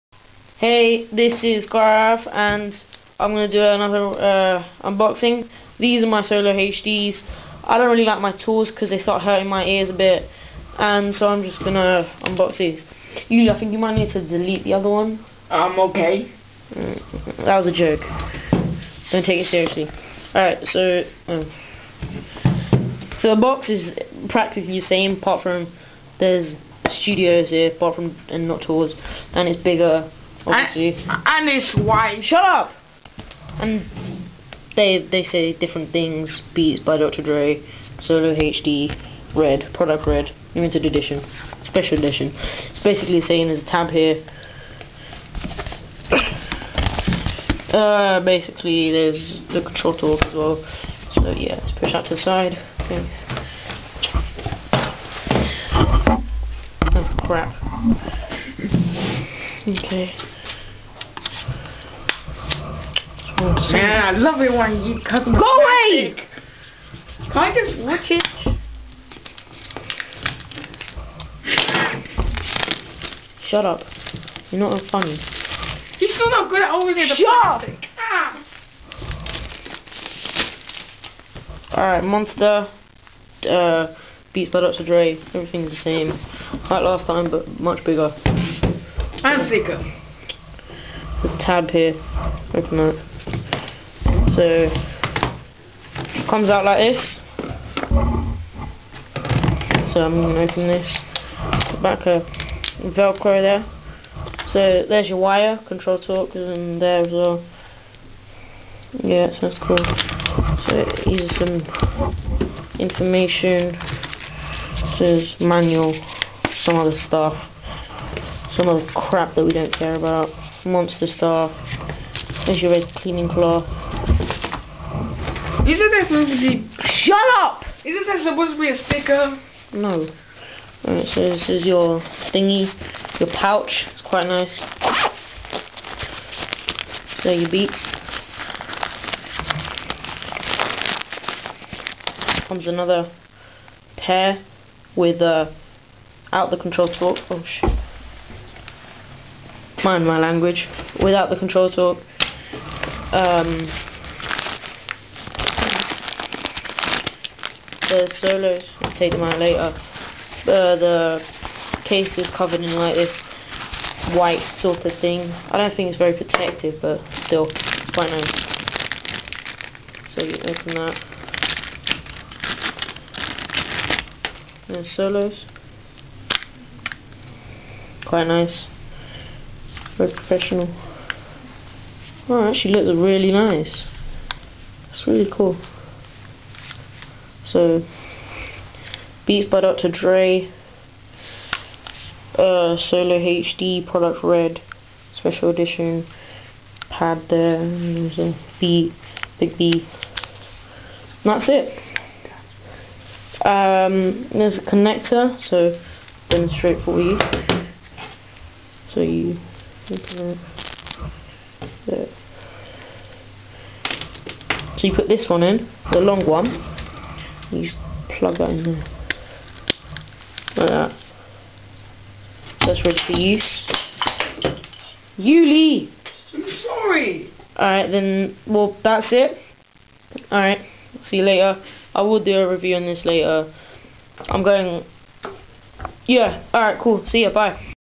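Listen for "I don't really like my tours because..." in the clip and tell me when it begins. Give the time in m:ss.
0:07.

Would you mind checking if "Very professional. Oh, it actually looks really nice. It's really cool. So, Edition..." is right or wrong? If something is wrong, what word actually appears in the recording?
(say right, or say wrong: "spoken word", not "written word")
wrong: "Beats", not "Edition".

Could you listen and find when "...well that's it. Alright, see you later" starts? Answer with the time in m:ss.
3:48.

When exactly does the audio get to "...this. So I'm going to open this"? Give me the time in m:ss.
1:36.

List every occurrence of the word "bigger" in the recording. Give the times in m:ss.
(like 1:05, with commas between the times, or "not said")
0:29, 1:27.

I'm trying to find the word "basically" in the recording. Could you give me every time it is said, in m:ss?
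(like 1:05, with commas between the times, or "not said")
0:42, 0:48.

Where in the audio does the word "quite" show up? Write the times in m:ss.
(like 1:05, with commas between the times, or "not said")
2:14, 2:47, 2:58.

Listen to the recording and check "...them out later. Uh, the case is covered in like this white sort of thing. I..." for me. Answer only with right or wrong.
right.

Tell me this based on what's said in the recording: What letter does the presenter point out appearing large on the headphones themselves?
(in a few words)
B.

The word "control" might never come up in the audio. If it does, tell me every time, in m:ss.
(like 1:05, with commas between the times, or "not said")
0:49, 1:45, 2:26, 2:31.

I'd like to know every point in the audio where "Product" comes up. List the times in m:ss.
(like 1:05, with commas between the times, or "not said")
0:39, 3:13.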